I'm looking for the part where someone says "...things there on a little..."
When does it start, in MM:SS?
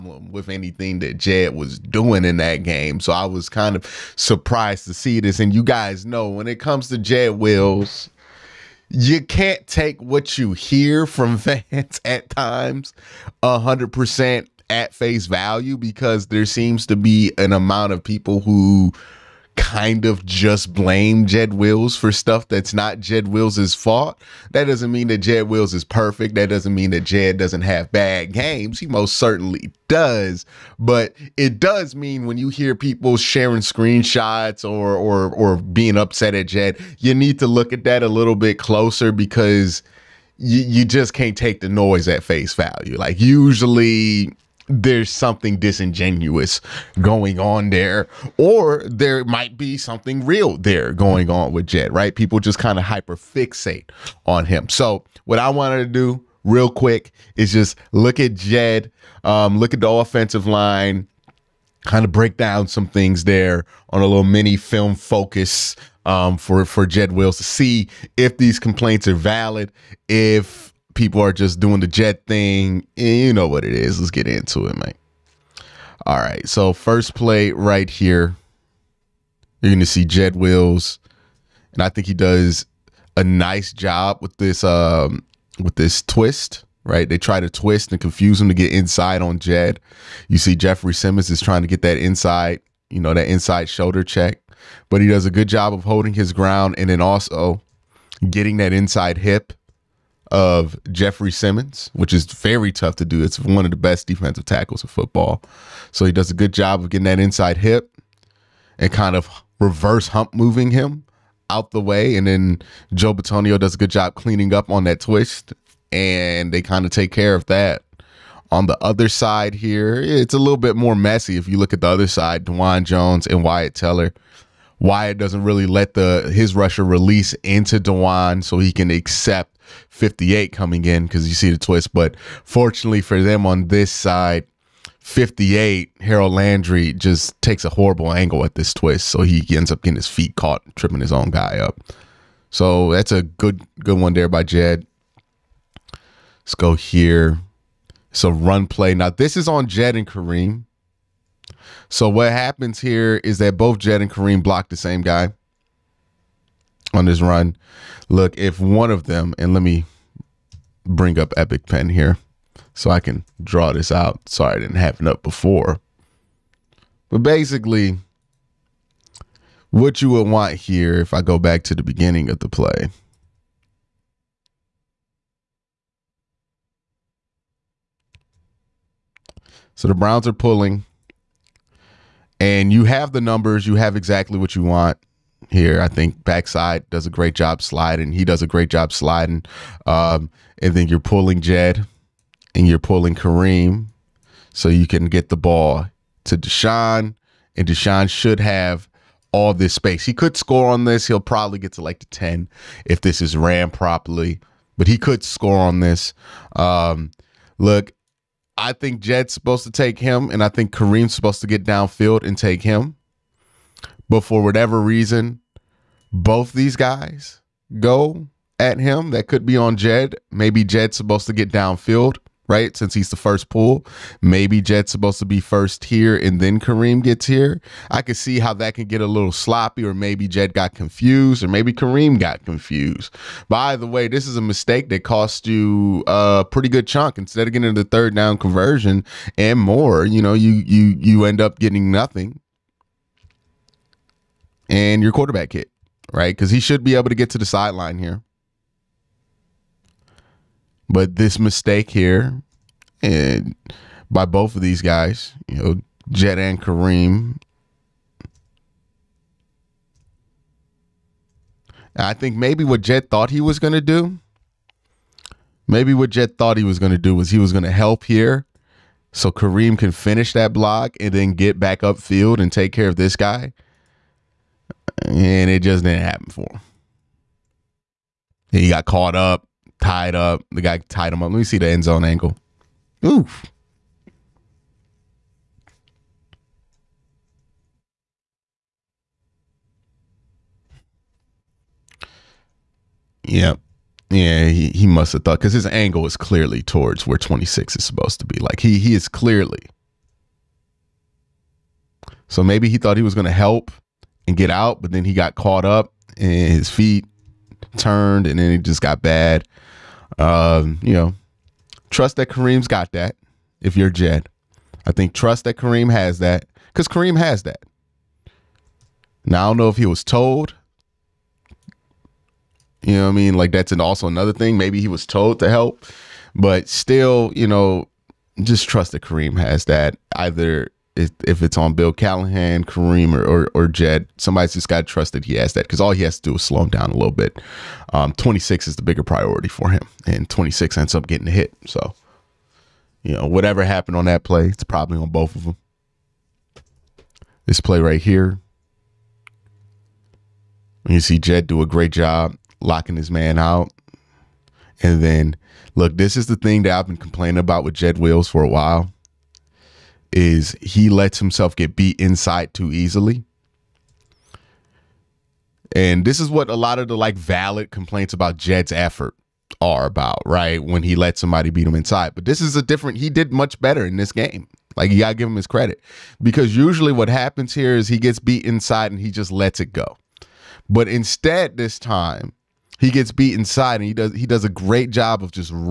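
01:02.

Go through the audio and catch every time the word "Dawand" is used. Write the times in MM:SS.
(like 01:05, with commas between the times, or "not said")
02:02, 02:07.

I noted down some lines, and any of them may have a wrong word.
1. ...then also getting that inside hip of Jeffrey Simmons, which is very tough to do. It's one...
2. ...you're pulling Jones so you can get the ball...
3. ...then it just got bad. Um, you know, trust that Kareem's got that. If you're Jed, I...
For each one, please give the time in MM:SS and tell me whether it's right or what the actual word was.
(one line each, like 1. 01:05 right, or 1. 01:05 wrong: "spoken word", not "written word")
1. 01:36 right
2. 03:12 wrong: "Kareem", not "Jones"
3. 05:08 right.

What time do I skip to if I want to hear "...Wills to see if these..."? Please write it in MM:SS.
01:07.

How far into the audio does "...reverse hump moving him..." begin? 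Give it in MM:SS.
01:49.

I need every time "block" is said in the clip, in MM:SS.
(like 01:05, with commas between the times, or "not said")
02:34, 04:30.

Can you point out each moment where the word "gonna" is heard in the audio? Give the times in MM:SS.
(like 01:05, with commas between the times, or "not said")
01:19, 05:03.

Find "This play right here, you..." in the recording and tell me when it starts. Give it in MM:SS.
05:47.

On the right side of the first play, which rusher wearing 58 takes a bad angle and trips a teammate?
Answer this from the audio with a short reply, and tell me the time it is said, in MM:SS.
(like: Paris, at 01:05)
Harold Landry, at 02:16.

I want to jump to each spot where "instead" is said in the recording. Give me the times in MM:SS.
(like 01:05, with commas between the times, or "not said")
03:57, 06:20.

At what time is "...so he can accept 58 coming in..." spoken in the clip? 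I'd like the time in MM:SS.
02:08.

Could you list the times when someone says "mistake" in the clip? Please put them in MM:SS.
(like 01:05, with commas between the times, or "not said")
03:54, 04:11.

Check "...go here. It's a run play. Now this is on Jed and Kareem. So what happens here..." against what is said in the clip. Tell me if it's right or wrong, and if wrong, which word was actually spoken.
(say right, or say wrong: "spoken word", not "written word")
right.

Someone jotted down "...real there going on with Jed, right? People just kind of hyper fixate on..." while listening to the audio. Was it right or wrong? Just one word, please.
right.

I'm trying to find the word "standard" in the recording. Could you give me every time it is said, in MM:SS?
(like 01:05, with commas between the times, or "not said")
not said.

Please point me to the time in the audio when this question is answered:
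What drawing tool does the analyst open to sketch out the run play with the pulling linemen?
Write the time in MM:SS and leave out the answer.
02:41.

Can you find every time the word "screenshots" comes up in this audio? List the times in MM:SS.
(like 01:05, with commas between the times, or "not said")
00:33.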